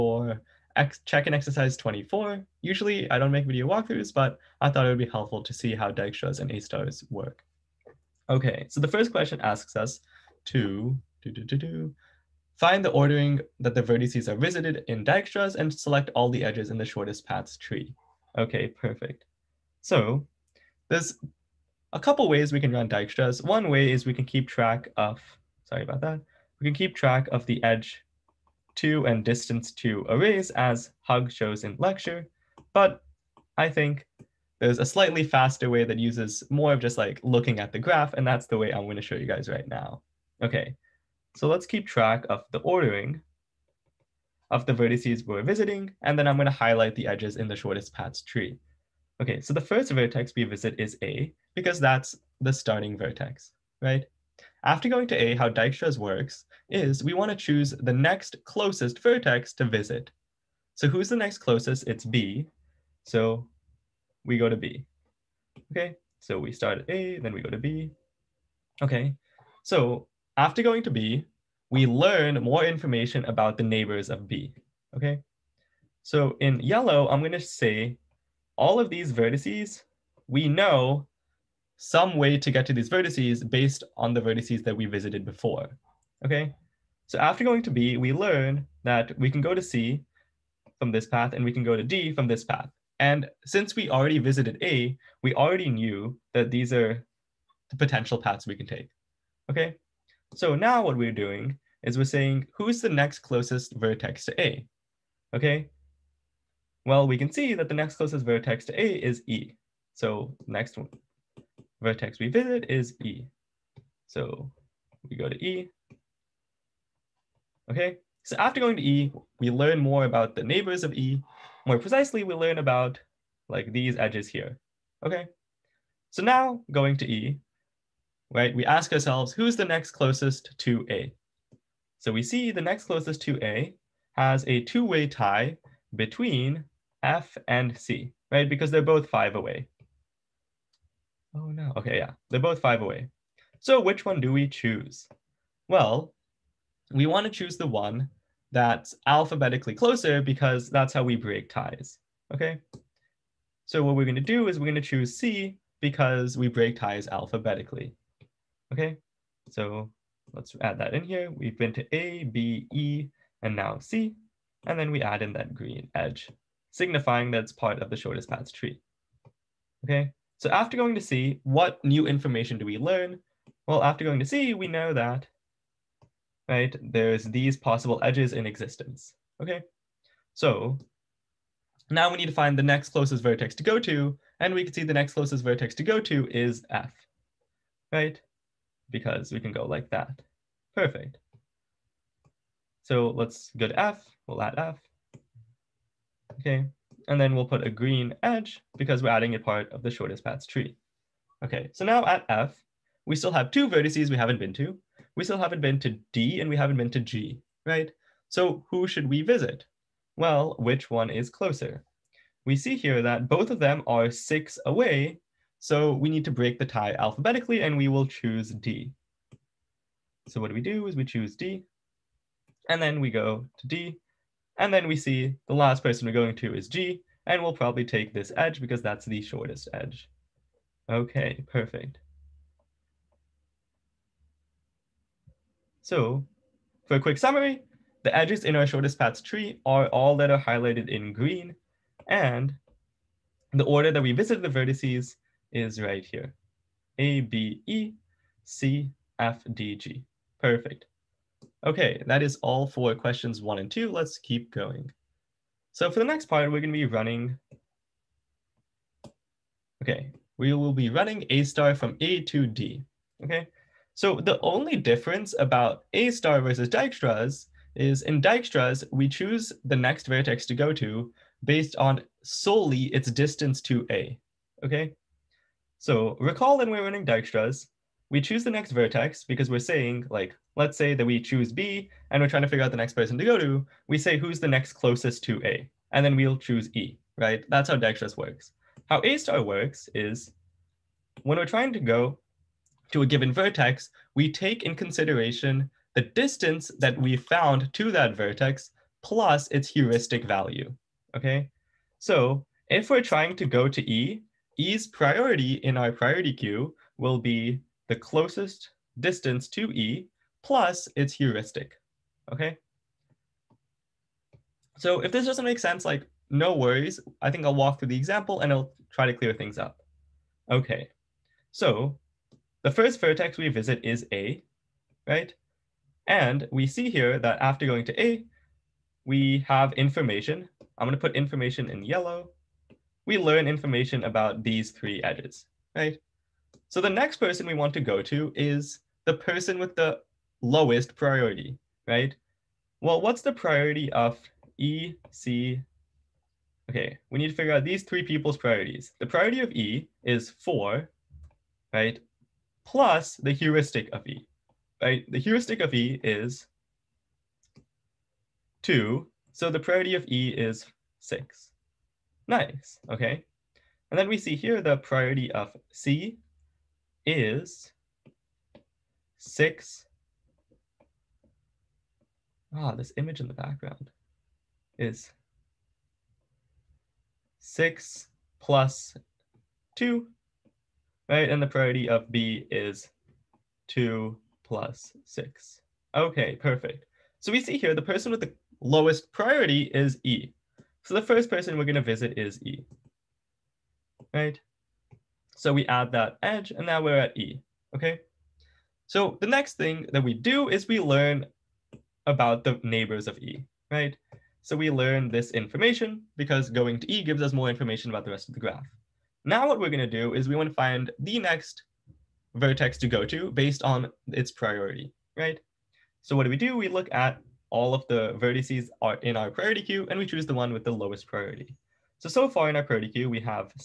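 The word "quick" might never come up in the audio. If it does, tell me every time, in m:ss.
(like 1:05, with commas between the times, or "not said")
3:56.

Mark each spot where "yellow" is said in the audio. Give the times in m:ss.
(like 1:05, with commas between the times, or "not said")
1:16, 5:31.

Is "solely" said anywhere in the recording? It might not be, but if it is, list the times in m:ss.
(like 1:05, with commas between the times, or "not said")
4:32.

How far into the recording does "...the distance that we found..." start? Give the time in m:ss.
4:55.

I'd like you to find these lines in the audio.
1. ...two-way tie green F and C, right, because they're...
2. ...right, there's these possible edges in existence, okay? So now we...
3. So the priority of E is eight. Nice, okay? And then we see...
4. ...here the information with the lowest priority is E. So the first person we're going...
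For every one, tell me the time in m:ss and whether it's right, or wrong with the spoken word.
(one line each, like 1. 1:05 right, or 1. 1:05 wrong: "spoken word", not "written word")
1. 2:14 wrong: "between", not "green"
2. 2:56 right
3. 5:59 wrong: "six", not "eight"
4. 6:27 wrong: "person", not "information".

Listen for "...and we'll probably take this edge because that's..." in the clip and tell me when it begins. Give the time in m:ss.
3:47.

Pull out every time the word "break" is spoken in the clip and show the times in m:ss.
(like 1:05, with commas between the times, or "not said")
2:31, 2:36, 3:36.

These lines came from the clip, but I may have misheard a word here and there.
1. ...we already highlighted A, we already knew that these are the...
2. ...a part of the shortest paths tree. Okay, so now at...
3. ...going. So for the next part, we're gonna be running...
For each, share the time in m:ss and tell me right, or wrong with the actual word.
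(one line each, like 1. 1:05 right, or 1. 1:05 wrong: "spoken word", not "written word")
1. 1:33 wrong: "visited", not "highlighted"
2. 3:19 right
3. 4:14 right.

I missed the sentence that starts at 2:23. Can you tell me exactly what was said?
So which one do we choose?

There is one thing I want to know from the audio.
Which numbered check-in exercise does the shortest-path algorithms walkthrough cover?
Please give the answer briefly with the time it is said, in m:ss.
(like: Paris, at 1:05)
24, at 0:01.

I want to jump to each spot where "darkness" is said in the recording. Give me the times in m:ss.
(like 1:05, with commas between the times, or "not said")
not said.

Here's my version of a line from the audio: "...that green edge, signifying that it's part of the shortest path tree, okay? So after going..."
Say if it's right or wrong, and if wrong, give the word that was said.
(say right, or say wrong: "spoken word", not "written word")
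right.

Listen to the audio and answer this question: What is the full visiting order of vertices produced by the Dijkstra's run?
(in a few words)
A, B, E, C, F, D, G.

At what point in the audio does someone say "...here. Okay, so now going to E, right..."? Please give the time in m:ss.
2:04.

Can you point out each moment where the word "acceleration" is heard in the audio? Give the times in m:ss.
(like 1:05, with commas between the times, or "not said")
not said.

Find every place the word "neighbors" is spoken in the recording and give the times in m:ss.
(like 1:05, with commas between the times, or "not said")
1:13, 2:00, 6:42.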